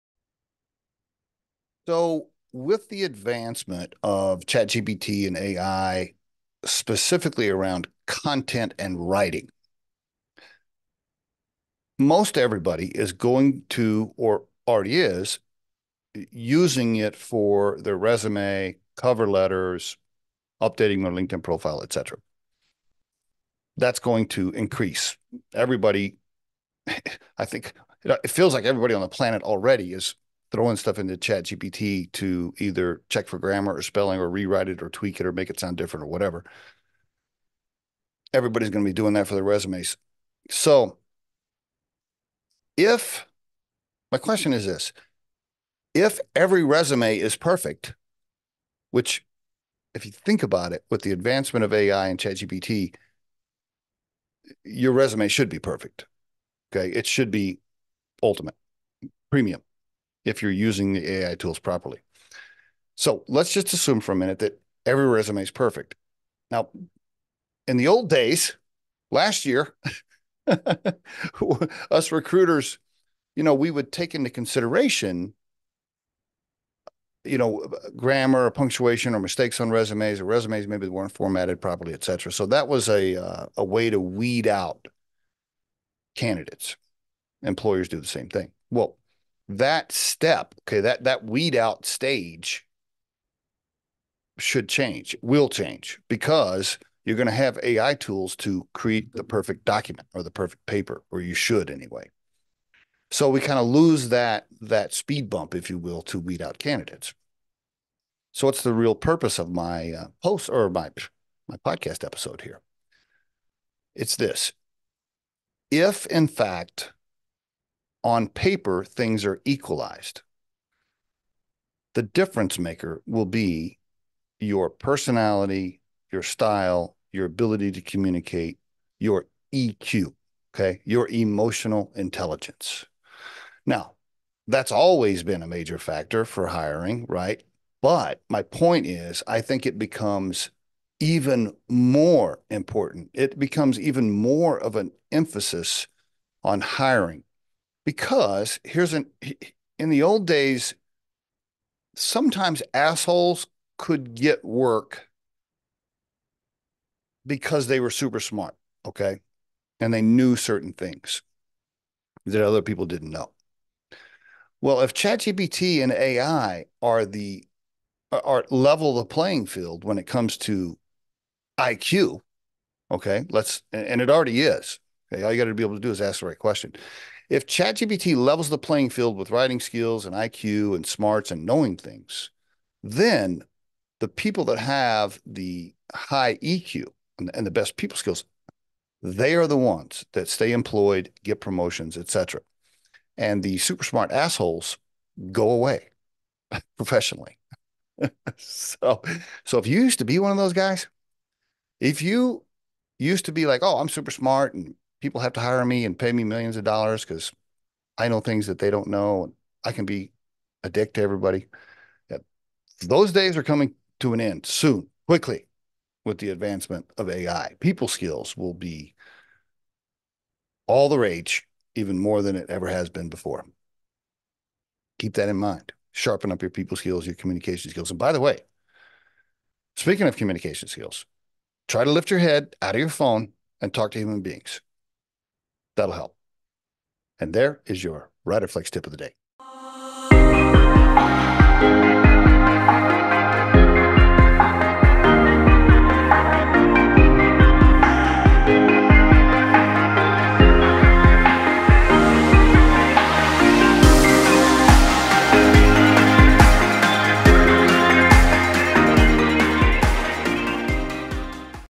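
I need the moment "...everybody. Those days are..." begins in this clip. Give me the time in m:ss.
3:31.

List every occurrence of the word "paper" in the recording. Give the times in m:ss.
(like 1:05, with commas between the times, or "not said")
1:40, 1:58.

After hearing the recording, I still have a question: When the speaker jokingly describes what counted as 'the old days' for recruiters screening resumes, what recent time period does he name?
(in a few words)
last year.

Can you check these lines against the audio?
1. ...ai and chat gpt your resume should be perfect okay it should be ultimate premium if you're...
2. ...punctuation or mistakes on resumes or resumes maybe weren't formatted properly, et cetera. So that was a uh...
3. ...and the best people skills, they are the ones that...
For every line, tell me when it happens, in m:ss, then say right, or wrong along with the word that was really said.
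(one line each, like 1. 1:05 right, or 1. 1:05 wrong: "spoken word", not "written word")
1. 0:51 right
2. 1:18 right
3. 3:07 right.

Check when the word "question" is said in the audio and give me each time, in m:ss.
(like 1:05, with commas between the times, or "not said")
0:44, 2:56.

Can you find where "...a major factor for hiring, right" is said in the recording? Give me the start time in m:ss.
2:15.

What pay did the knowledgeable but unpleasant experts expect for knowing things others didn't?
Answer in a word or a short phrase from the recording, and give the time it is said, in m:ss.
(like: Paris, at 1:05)
millions of dollars, at 3:26.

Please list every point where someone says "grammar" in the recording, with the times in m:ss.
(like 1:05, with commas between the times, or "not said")
0:33, 1:17.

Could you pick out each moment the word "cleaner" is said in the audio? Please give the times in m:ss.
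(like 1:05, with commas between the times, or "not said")
not said.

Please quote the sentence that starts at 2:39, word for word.
And they knew certain things that other people didn't know.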